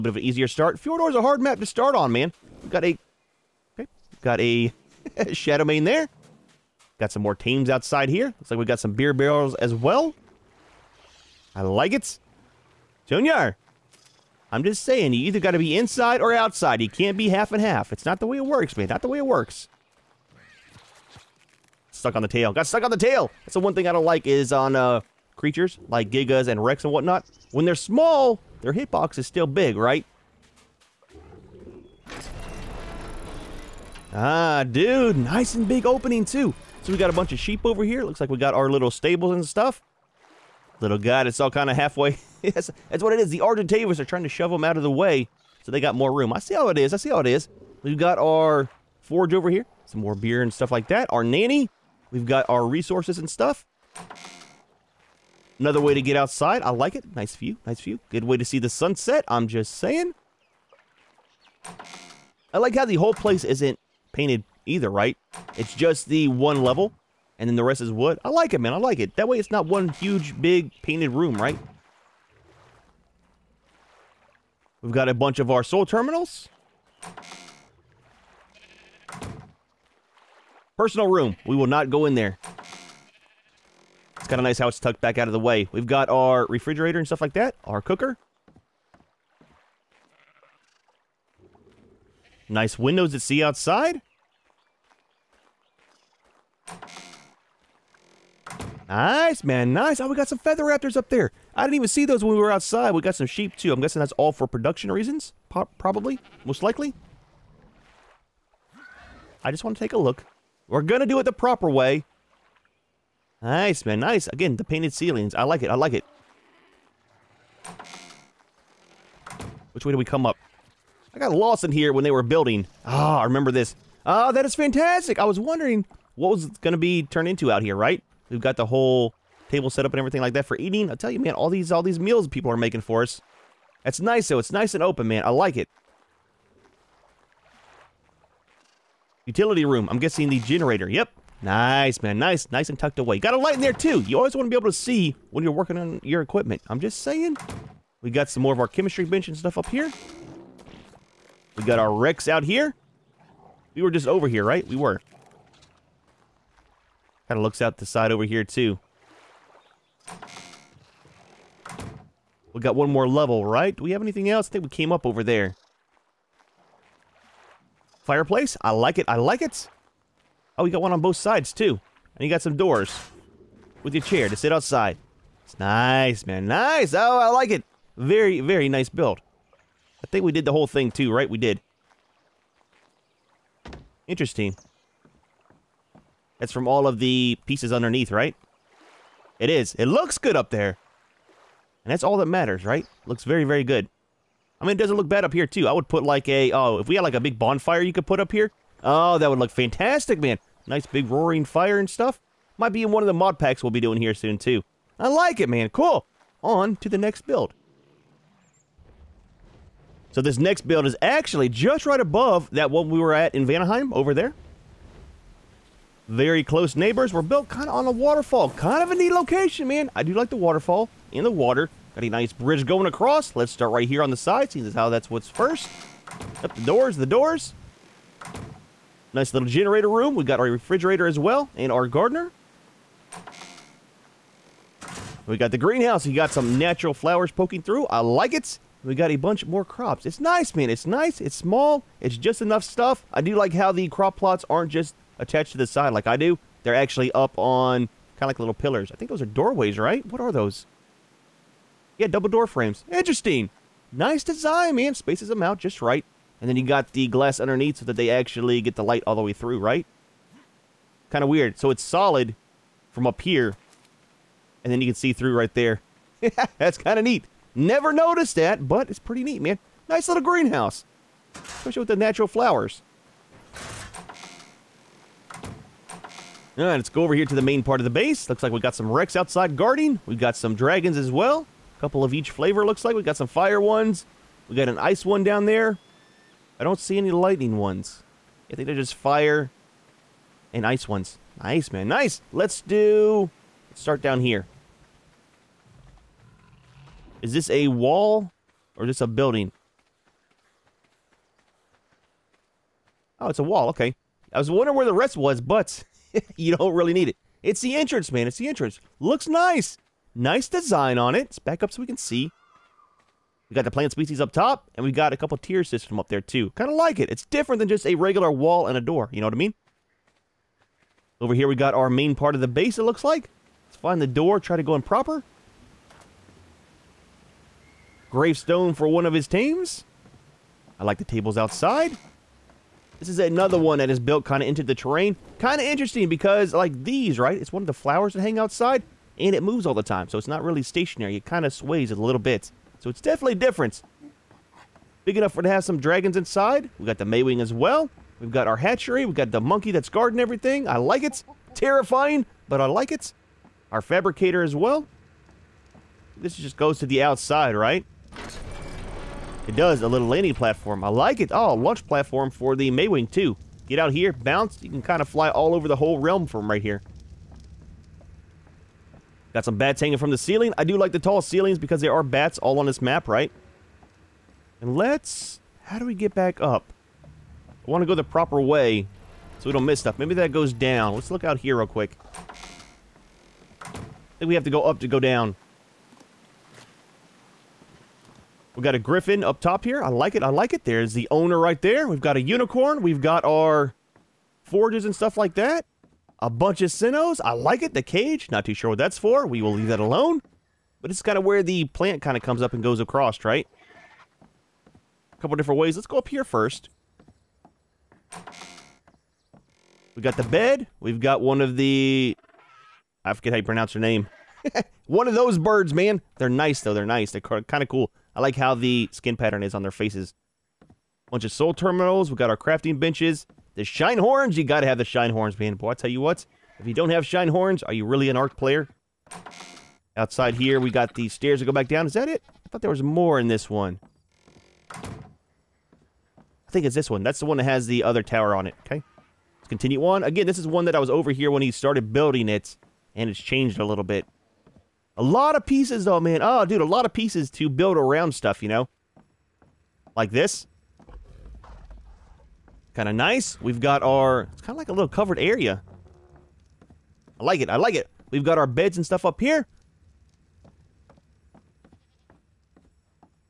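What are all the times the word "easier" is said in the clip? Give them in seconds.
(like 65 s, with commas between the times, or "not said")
0 s.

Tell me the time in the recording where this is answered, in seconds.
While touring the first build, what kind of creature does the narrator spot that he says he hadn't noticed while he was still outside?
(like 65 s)
100 s.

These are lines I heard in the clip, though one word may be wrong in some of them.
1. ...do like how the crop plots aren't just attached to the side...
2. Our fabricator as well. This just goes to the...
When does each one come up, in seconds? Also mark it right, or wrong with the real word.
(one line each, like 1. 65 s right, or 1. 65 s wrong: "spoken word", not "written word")
1. 243 s right
2. 353 s right.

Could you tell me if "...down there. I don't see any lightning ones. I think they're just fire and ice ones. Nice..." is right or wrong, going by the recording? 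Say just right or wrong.
right.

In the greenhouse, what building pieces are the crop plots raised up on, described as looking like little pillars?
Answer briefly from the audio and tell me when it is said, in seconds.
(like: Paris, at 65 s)
Double door frames, at 252 s.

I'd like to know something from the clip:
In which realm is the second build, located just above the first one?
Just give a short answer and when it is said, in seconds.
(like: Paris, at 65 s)
Vanaheim, at 213 s.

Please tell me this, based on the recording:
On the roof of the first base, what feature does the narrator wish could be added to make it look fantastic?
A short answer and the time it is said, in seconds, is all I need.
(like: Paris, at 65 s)
Big bonfire, at 197 s.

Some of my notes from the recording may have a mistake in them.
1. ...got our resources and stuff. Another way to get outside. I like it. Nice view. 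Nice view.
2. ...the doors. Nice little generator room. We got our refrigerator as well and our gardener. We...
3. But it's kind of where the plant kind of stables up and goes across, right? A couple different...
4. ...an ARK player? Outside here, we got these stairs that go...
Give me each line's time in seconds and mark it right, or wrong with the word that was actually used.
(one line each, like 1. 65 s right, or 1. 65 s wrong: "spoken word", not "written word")
1. 52 s right
2. 226 s right
3. 400 s wrong: "comes", not "stables"
4. 428 s right.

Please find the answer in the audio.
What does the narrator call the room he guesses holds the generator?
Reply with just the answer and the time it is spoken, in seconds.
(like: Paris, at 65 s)
Utility room, at 139 s.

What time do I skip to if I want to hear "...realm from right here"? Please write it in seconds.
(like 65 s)
365 s.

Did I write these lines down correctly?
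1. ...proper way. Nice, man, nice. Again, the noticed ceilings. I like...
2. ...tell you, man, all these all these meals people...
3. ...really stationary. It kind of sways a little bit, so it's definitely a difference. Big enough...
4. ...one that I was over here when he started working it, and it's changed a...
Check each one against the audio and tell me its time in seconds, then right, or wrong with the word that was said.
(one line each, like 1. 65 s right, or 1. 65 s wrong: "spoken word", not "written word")
1. 111 s wrong: "painted", not "noticed"
2. 130 s right
3. 340 s right
4. 440 s wrong: "building", not "working".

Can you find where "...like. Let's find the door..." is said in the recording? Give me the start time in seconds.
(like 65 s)
323 s.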